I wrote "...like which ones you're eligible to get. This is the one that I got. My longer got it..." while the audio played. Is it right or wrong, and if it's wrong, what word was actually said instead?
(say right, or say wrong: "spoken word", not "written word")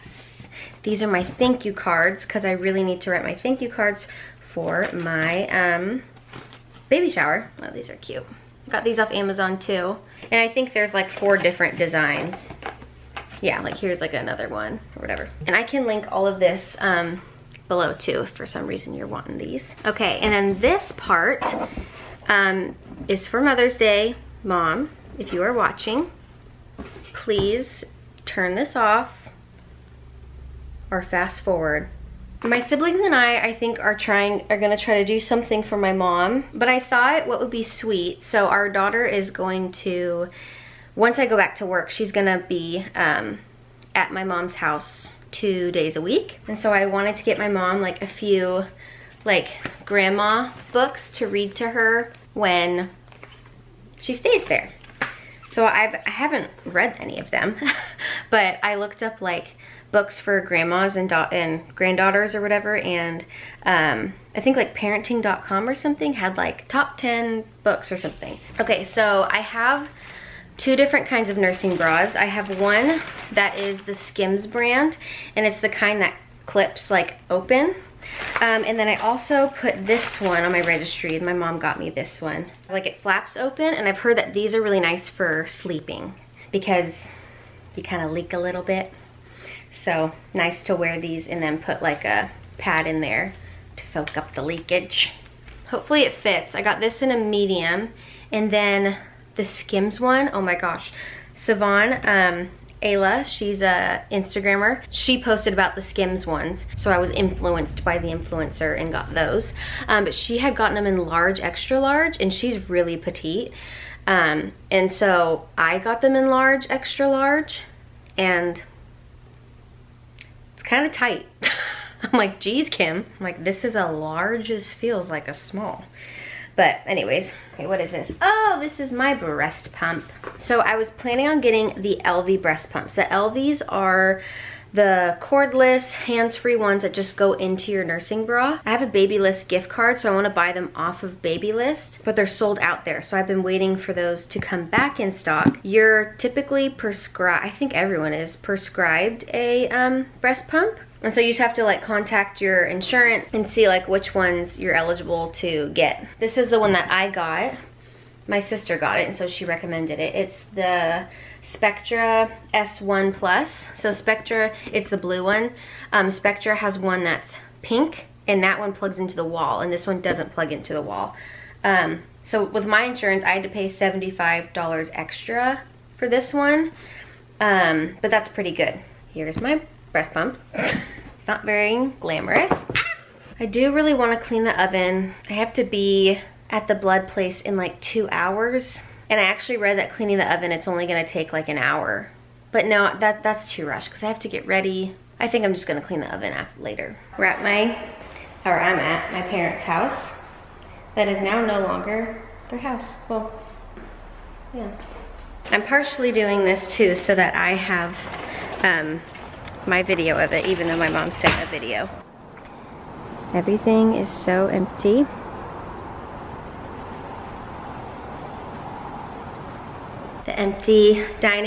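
wrong: "sister", not "longer".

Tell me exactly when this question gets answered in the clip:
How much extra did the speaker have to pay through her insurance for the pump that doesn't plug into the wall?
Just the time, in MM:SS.
02:53.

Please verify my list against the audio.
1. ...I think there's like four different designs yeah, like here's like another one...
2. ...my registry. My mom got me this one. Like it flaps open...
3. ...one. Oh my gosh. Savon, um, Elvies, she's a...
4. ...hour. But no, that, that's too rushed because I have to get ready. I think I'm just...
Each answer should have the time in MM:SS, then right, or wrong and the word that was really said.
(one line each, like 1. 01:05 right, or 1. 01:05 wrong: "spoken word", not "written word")
1. 00:10 right
2. 01:20 right
3. 01:40 wrong: "Ayla", not "Elvies"
4. 03:11 right.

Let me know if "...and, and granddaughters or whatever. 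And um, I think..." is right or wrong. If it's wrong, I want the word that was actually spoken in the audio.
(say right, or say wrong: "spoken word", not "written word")
right.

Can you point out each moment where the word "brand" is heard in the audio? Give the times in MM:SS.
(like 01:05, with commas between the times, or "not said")
01:14.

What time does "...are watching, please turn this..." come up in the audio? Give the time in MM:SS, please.
00:25.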